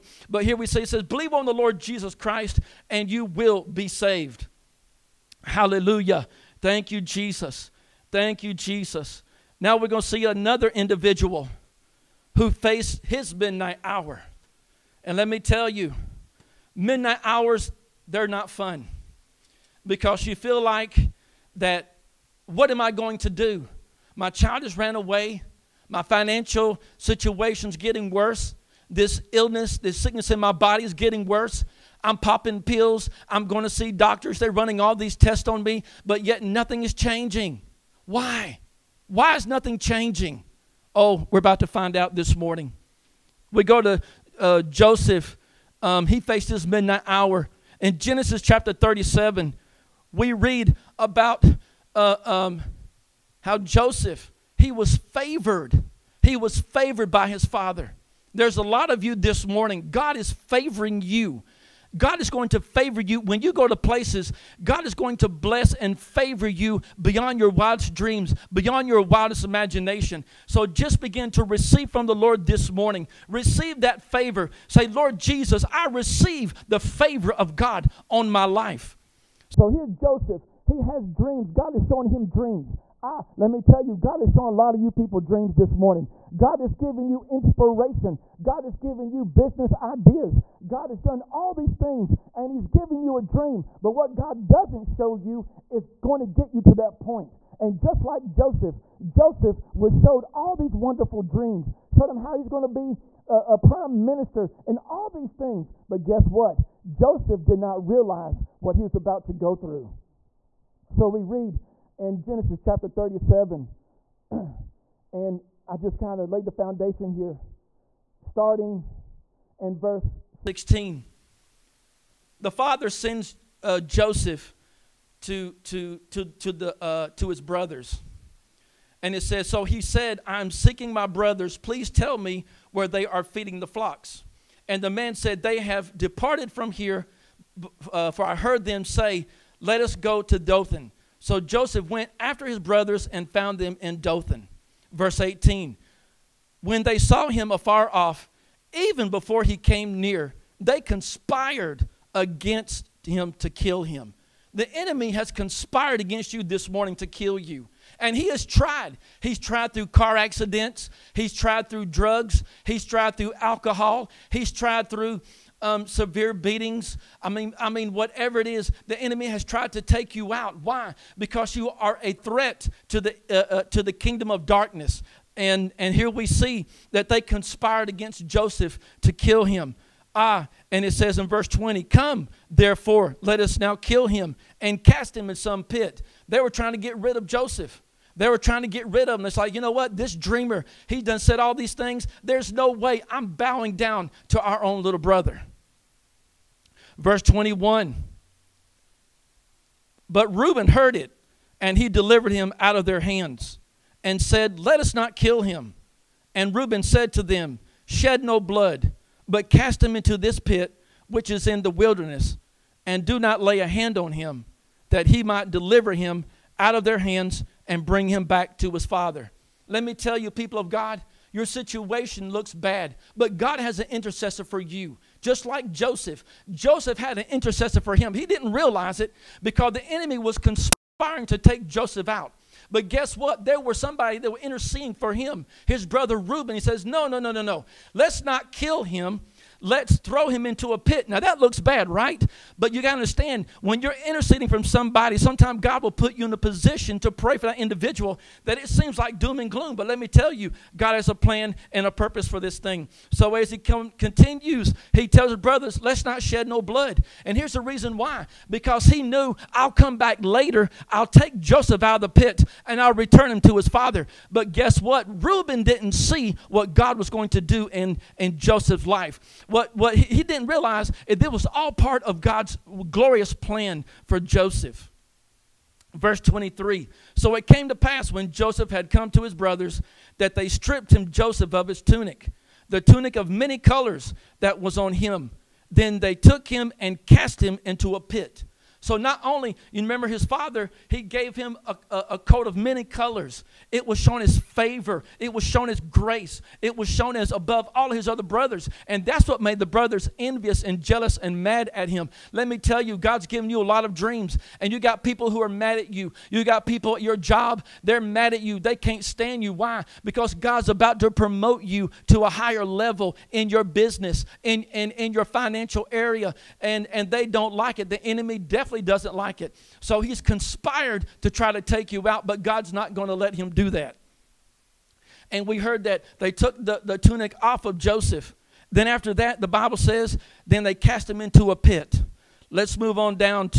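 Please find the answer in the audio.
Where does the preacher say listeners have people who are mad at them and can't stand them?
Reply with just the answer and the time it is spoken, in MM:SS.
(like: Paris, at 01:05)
At your job, at 05:07.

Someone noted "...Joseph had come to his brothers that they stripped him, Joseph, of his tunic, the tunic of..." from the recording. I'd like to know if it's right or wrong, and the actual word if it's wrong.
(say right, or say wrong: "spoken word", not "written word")
right.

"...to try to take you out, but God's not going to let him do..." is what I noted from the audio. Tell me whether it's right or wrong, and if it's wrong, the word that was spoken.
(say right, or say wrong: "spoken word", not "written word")
right.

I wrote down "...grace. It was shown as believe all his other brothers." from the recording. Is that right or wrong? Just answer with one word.
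wrong.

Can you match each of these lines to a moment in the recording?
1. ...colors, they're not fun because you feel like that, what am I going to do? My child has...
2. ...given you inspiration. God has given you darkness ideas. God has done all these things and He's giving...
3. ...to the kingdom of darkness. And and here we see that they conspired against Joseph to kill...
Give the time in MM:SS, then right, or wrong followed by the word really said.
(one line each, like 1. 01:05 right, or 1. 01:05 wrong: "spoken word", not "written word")
1. 00:17 wrong: "hours", not "colors"
2. 01:26 wrong: "business", not "darkness"
3. 02:53 right.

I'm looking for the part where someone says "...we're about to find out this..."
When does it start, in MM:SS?
00:41.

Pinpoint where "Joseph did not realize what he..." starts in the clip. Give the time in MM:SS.
01:46.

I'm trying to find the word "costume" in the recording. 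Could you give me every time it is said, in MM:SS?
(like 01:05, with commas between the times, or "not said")
not said.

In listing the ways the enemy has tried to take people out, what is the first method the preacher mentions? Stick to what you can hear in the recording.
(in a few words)
Car accidents.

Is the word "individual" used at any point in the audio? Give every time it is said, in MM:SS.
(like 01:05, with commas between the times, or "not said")
00:10, 04:07.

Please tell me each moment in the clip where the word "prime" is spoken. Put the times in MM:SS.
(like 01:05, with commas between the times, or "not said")
01:43.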